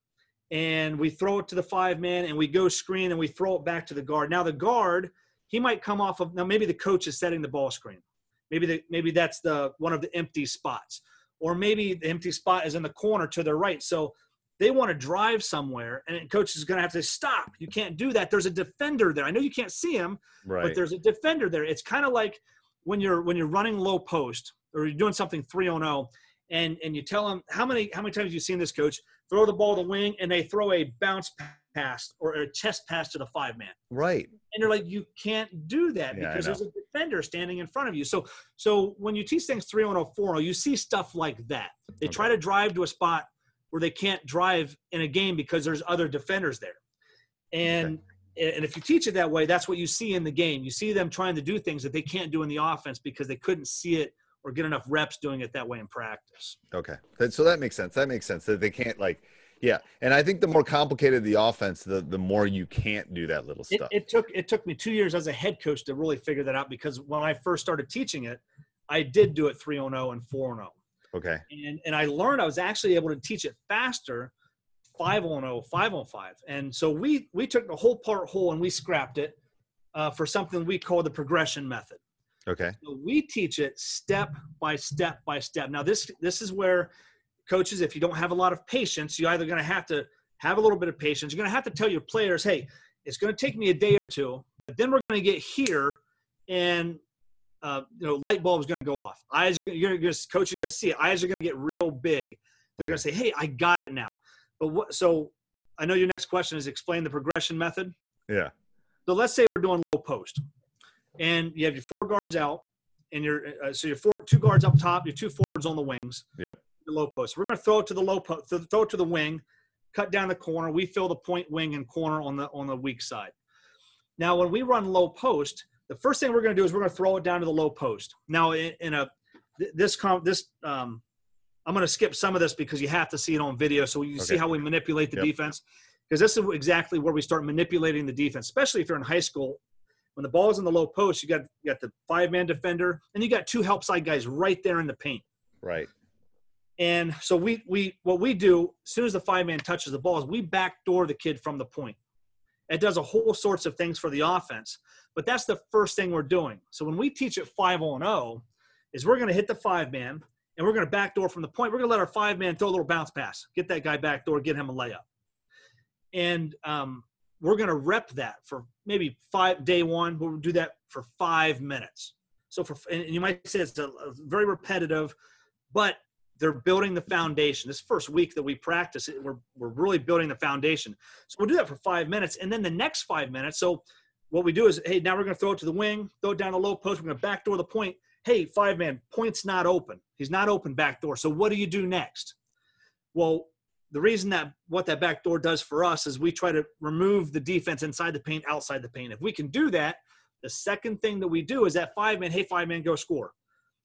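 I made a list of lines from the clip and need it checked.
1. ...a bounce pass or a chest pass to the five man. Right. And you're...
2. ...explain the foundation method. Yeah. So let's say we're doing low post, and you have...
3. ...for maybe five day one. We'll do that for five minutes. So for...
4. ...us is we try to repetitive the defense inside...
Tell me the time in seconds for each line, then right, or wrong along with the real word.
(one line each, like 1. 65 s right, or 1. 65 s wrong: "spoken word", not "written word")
1. 30 s right
2. 106 s wrong: "progression", not "foundation"
3. 168 s right
4. 195 s wrong: "remove", not "repetitive".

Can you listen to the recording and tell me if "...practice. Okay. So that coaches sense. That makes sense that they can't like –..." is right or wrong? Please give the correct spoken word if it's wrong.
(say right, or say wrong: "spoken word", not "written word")
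wrong: "makes", not "coaches".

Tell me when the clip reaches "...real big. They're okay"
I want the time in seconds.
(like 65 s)
101 s.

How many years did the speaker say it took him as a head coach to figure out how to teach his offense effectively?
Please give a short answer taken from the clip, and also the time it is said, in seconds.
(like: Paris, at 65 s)
2 years, at 64 s.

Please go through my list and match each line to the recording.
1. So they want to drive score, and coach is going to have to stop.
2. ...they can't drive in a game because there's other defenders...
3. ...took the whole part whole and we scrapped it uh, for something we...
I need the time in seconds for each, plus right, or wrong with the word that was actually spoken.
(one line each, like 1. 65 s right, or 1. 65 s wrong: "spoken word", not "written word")
1. 13 s wrong: "somewhere", not "score"
2. 43 s right
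3. 77 s right.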